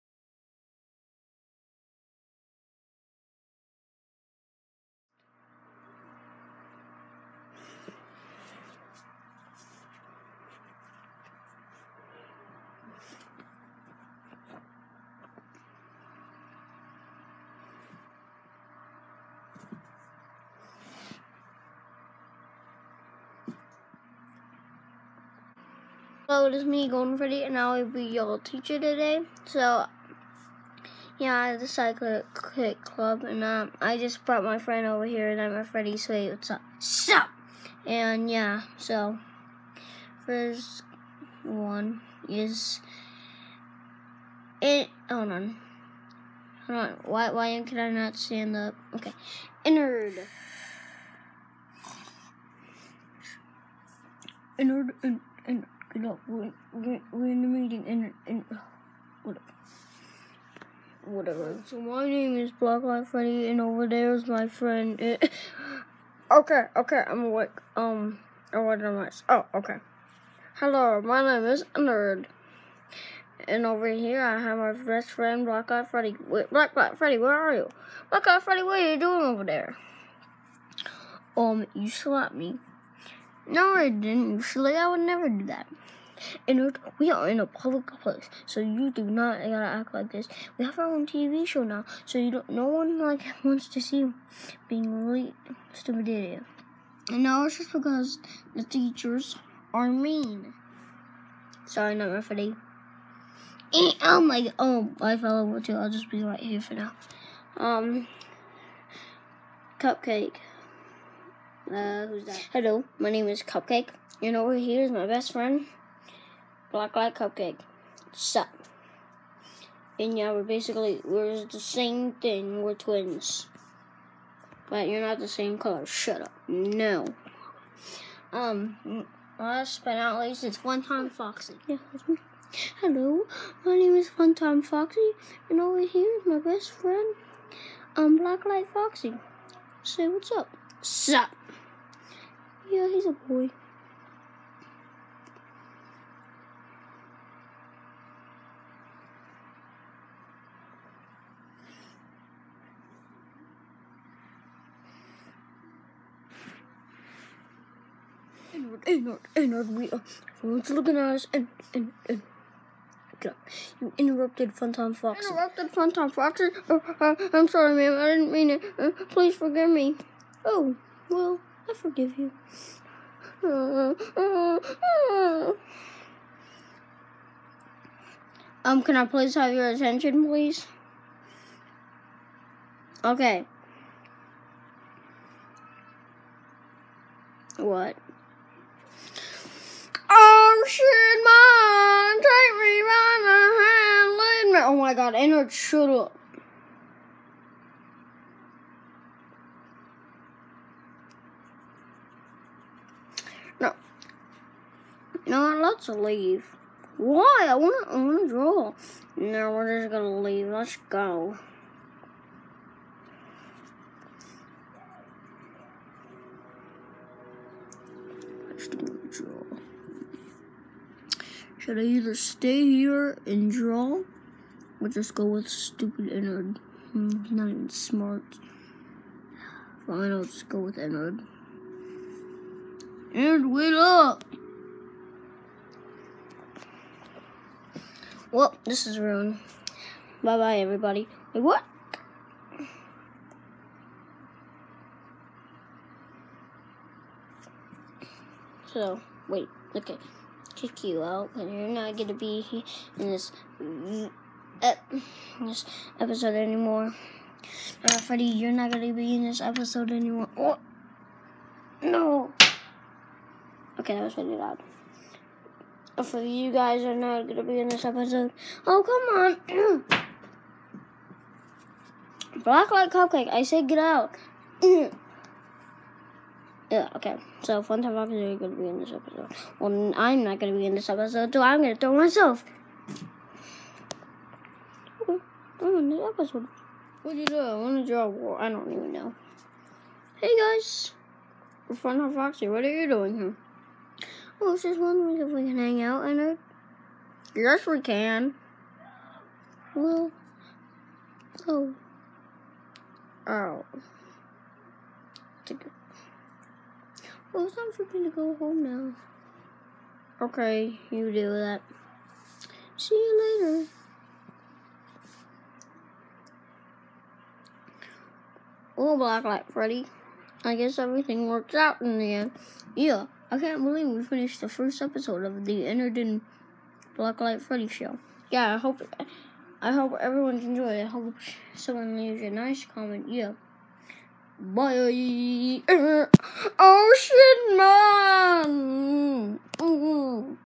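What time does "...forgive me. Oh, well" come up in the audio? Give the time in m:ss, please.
2:49.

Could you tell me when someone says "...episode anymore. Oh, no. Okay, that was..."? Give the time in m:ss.
4:19.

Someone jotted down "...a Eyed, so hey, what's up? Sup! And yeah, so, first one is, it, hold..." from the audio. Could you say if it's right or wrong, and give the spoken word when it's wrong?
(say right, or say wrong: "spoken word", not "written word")
wrong: "Freddy", not "Eyed".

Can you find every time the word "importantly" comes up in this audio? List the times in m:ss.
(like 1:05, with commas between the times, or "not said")
not said.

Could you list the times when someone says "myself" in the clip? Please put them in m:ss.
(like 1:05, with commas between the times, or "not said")
4:41.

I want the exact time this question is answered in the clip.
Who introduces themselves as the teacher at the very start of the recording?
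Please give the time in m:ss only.
0:26.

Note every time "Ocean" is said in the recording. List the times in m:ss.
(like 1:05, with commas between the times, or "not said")
5:34.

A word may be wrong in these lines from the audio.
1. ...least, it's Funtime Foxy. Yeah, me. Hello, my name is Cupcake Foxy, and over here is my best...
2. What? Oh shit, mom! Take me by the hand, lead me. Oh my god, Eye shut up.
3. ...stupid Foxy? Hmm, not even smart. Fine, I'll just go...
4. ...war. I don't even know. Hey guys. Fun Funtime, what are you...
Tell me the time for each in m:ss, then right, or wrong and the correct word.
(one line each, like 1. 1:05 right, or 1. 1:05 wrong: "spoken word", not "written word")
1. 2:10 wrong: "Funtime", not "Cupcake"
2. 3:07 wrong: "Ennard", not "Eye"
3. 3:45 wrong: "Ennard", not "Foxy"
4. 4:48 wrong: "Foxy", not "Funtime".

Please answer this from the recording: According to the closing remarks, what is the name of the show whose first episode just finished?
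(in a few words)
The Ennard and Blacklight Freddy Show.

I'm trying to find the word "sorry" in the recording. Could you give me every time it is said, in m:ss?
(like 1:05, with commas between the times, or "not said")
1:41, 2:47.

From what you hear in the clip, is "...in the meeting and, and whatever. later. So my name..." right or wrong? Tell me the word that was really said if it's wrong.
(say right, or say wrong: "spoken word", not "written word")
wrong: "whatever", not "later".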